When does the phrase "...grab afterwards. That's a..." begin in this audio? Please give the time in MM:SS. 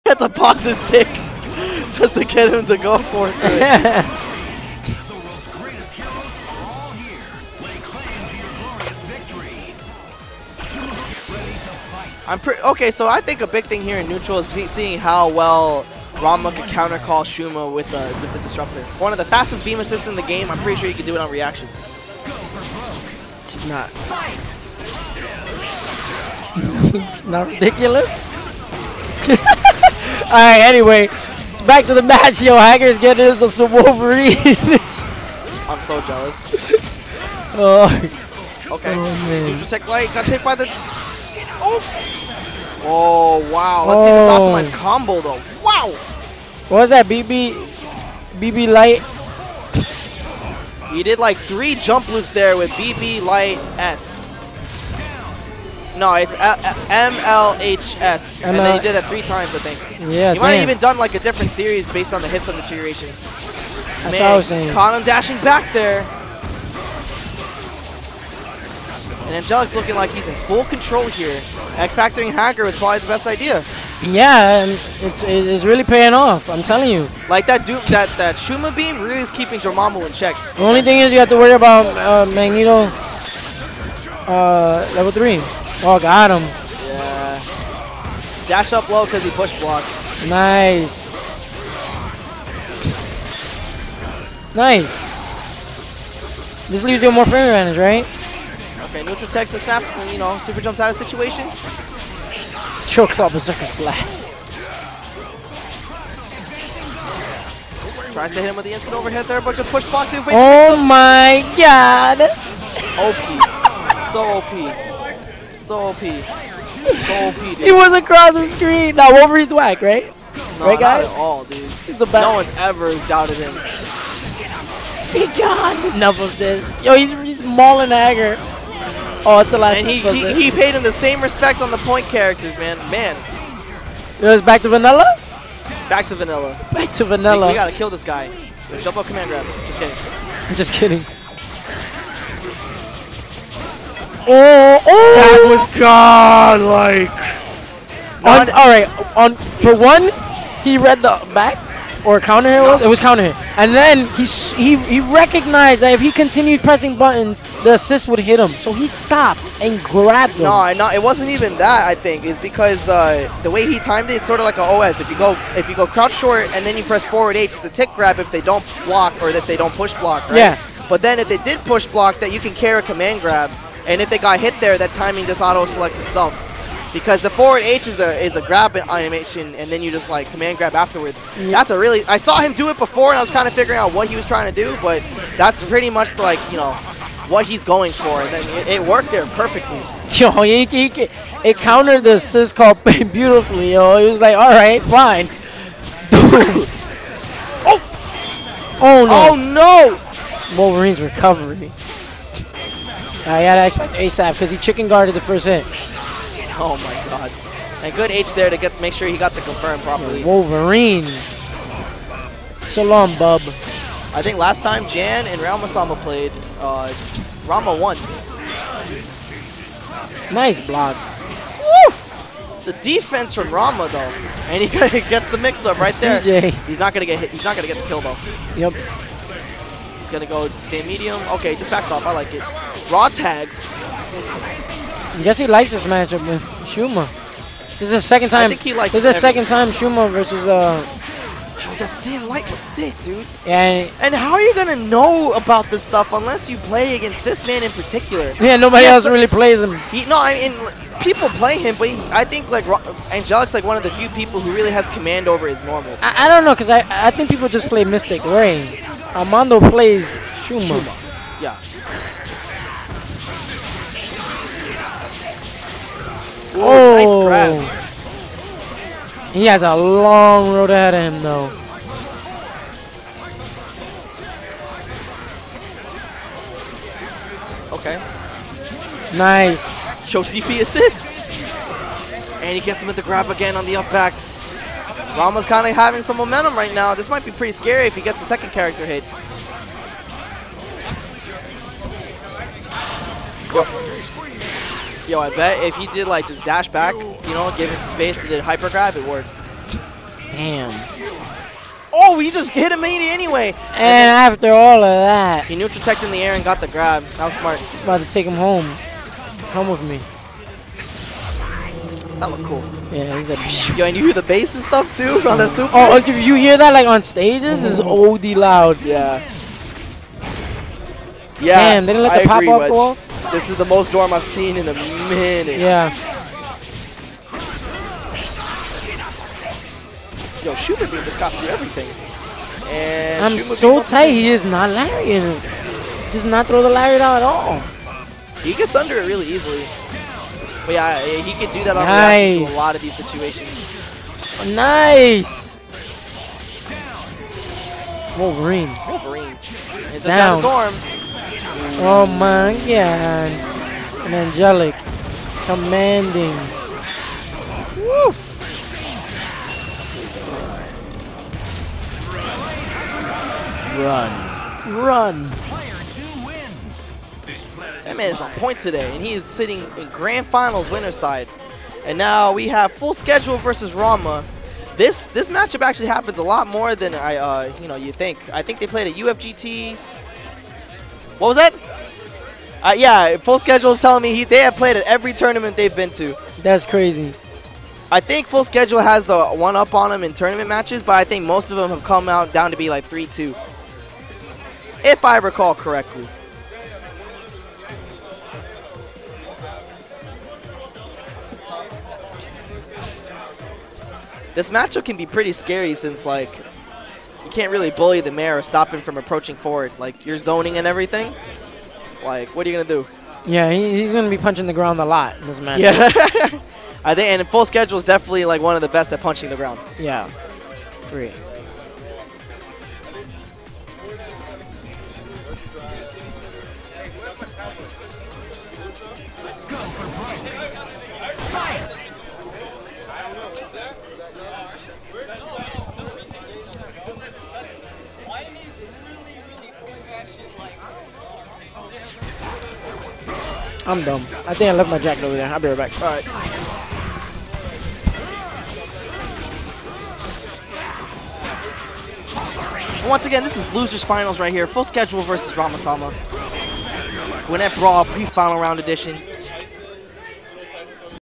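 03:00.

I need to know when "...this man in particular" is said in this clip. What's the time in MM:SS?
04:07.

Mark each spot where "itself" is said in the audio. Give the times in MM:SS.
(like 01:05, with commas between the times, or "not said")
02:55.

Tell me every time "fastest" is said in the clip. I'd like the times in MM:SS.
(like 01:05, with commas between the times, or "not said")
00:19.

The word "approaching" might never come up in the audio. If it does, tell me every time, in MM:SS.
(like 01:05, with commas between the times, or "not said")
06:48.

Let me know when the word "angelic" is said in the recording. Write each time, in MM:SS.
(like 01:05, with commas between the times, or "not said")
01:09, 04:13, 05:54.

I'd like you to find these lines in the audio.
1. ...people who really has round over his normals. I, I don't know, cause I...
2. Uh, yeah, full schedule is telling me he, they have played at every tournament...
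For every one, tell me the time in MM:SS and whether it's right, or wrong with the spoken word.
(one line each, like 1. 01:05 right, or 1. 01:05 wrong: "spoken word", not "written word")
1. 04:14 wrong: "command", not "round"
2. 06:22 right.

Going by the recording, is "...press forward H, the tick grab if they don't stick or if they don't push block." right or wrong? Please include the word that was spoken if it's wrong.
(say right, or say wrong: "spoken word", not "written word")
wrong: "block", not "stick".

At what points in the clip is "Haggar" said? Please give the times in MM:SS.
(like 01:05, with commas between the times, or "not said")
00:32, 01:12, 02:07.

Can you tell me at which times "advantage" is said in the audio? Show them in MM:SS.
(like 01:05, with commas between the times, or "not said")
01:37.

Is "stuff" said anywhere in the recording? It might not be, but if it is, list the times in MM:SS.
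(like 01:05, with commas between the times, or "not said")
04:05, 05:14.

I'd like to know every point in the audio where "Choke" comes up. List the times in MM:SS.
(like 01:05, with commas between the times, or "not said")
01:42.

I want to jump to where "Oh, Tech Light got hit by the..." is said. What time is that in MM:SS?
00:38.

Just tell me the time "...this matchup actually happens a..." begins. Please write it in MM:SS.
06:15.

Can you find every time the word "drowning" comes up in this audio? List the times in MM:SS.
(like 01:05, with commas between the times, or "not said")
not said.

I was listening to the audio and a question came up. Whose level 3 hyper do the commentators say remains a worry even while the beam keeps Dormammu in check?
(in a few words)
Magneto.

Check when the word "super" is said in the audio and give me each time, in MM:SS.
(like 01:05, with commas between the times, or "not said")
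01:40, 05:15.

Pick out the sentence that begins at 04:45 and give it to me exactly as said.
Rama's kind of having some momentum right now.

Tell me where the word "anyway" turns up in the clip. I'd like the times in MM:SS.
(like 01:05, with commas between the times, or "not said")
00:30, 05:02.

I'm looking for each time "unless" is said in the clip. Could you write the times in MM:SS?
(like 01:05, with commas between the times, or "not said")
04:06.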